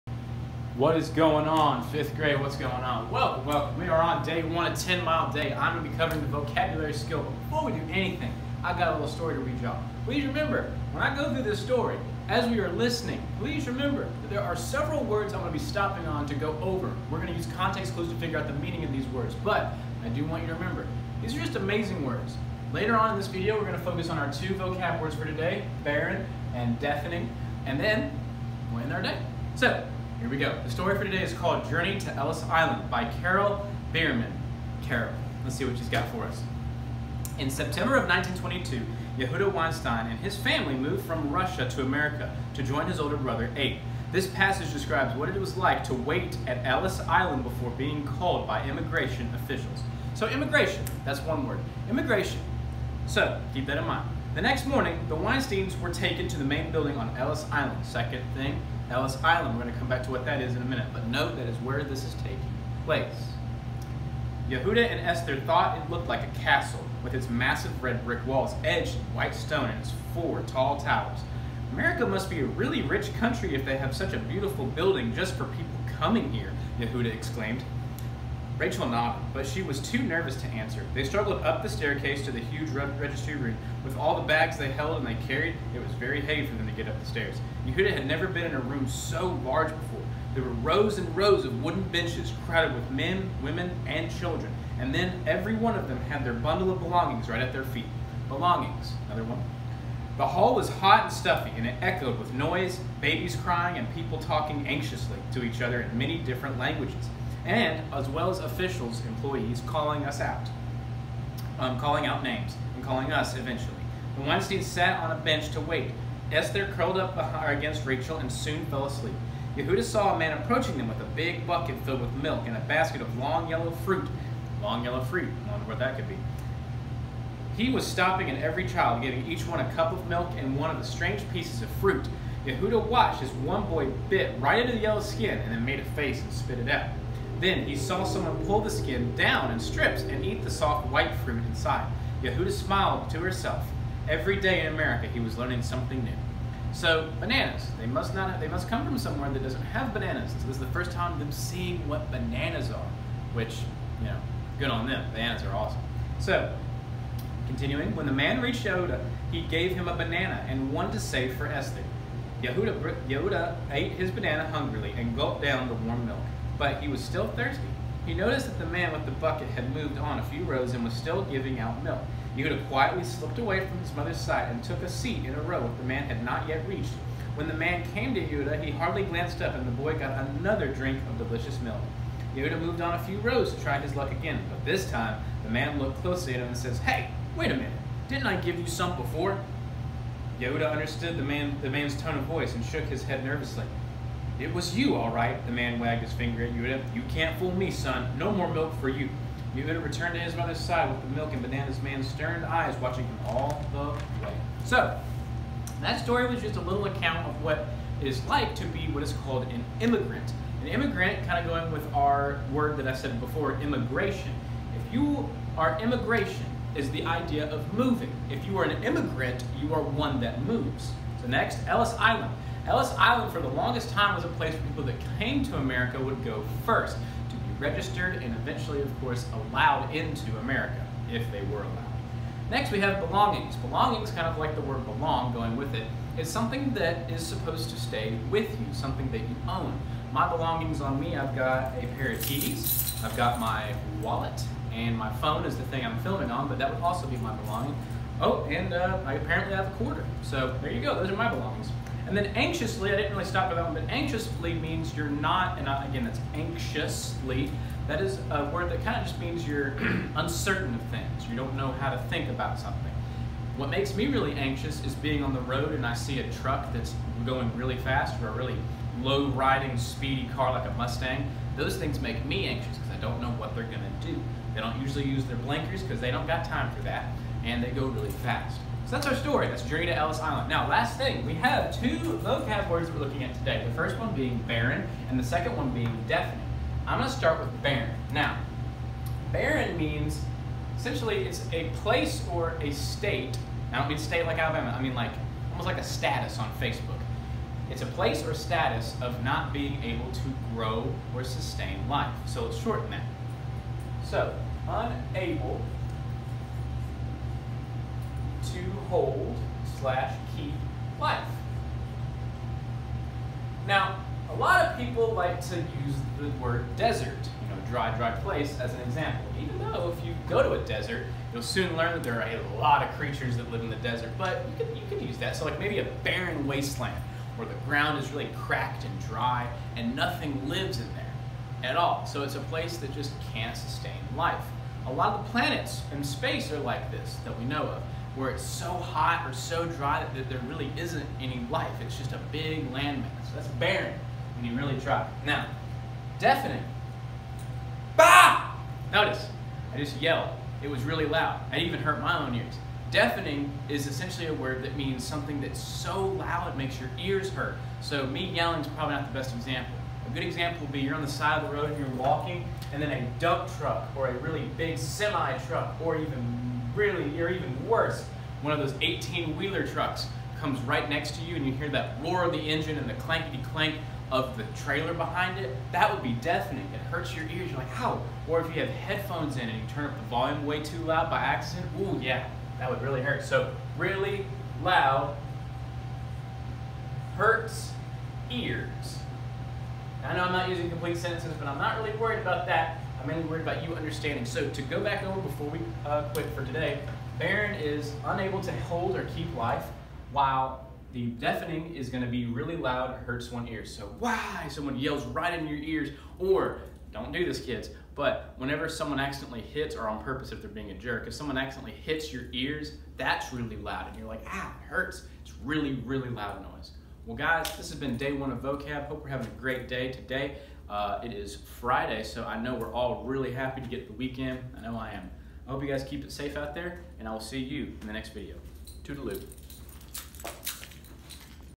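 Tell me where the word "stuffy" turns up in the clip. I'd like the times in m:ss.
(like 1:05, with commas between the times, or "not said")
1:41.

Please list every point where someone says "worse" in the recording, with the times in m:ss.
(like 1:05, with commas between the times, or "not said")
6:07.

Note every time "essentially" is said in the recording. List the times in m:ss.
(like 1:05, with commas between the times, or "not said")
4:50, 5:53.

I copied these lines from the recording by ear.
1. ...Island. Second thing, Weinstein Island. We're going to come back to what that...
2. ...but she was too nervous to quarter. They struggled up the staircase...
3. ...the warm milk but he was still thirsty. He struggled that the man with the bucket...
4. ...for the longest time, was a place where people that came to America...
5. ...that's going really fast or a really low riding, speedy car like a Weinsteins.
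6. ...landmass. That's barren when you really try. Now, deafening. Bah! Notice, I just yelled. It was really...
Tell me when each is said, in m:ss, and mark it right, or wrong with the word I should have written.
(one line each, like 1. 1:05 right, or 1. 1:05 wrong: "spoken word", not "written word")
1. 0:57 wrong: "Ellis", not "Weinstein"
2. 1:19 wrong: "answer", not "quarter"
3. 2:45 wrong: "noticed", not "struggled"
4. 3:43 right
5. 4:26 wrong: "Mustang", not "Weinsteins"
6. 5:42 right.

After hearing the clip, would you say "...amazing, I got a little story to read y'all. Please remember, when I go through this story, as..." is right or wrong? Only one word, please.
wrong.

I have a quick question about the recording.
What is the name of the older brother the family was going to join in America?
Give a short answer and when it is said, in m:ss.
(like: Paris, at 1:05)
Abe, at 0:43.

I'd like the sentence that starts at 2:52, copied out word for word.
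Yehuda quietly slipped away from his mother's side and took a seat in a row the man had not yet reached.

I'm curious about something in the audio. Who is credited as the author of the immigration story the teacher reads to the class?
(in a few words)
Carol Behrman.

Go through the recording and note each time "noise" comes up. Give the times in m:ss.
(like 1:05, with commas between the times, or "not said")
1:42, 6:56.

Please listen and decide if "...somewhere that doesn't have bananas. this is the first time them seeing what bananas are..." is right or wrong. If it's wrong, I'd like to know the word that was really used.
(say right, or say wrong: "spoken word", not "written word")
right.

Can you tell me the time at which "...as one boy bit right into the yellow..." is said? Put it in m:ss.
2:13.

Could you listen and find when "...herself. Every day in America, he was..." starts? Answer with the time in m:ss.
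2:23.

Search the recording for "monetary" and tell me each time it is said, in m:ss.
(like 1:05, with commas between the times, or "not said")
not said.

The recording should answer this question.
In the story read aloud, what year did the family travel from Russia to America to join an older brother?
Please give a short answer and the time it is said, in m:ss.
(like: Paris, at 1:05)
1922, at 0:38.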